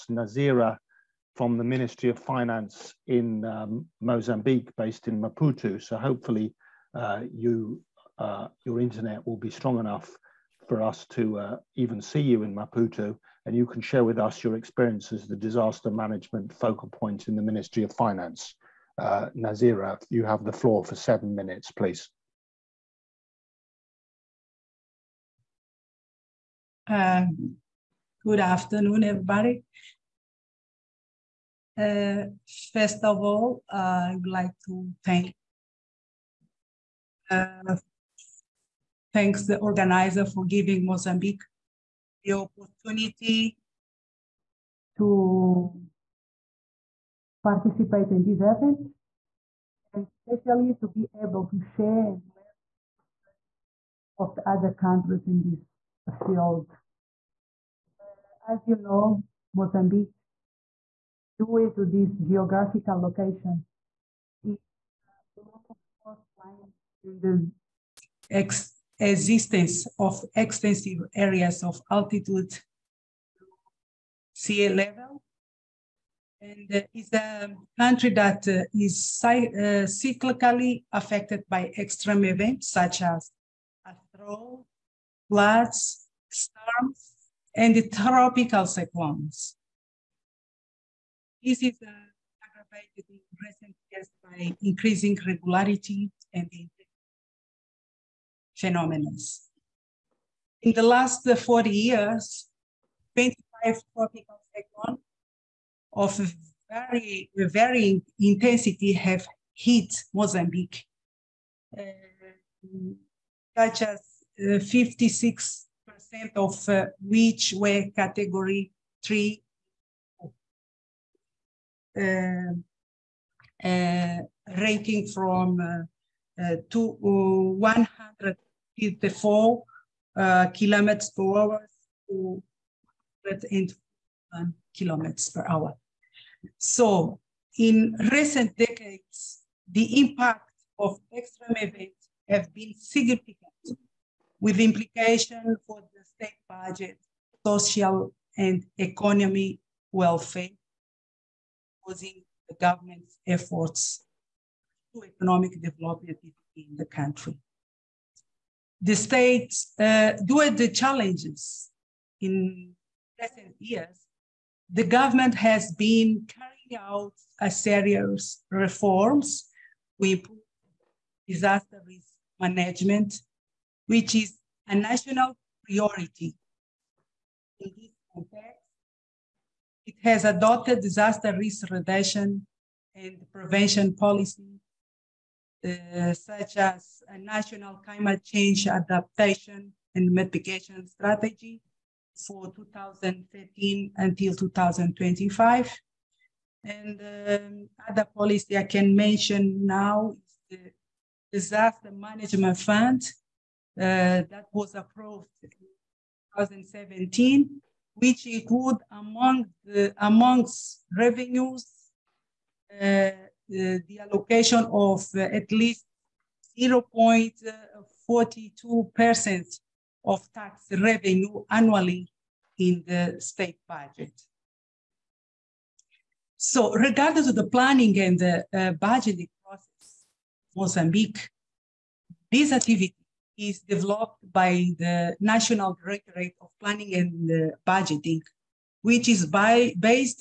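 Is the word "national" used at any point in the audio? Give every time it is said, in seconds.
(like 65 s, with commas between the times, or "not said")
174 s, 187 s, 235 s.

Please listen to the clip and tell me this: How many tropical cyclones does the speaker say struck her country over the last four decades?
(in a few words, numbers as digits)
25.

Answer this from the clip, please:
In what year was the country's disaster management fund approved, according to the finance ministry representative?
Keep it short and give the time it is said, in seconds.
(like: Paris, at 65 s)
2017, at 206 s.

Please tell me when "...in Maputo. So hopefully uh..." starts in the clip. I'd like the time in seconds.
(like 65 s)
5 s.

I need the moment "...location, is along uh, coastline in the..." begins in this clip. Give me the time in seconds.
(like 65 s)
63 s.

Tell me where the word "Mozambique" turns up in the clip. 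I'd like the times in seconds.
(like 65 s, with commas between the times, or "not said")
4 s, 40 s, 59 s, 110 s, 230 s.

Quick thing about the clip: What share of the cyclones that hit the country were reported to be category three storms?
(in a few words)
56%.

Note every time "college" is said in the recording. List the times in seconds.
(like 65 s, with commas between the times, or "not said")
not said.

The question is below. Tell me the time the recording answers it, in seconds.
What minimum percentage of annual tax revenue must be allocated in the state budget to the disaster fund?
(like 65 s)
216 s.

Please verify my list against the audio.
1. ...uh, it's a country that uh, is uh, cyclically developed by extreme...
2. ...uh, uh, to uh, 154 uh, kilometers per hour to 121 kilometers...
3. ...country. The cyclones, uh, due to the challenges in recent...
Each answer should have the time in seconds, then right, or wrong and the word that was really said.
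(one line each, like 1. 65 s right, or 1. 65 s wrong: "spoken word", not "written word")
1. 76 s wrong: "affected", not "developed"
2. 125 s right
3. 156 s wrong: "states", not "cyclones".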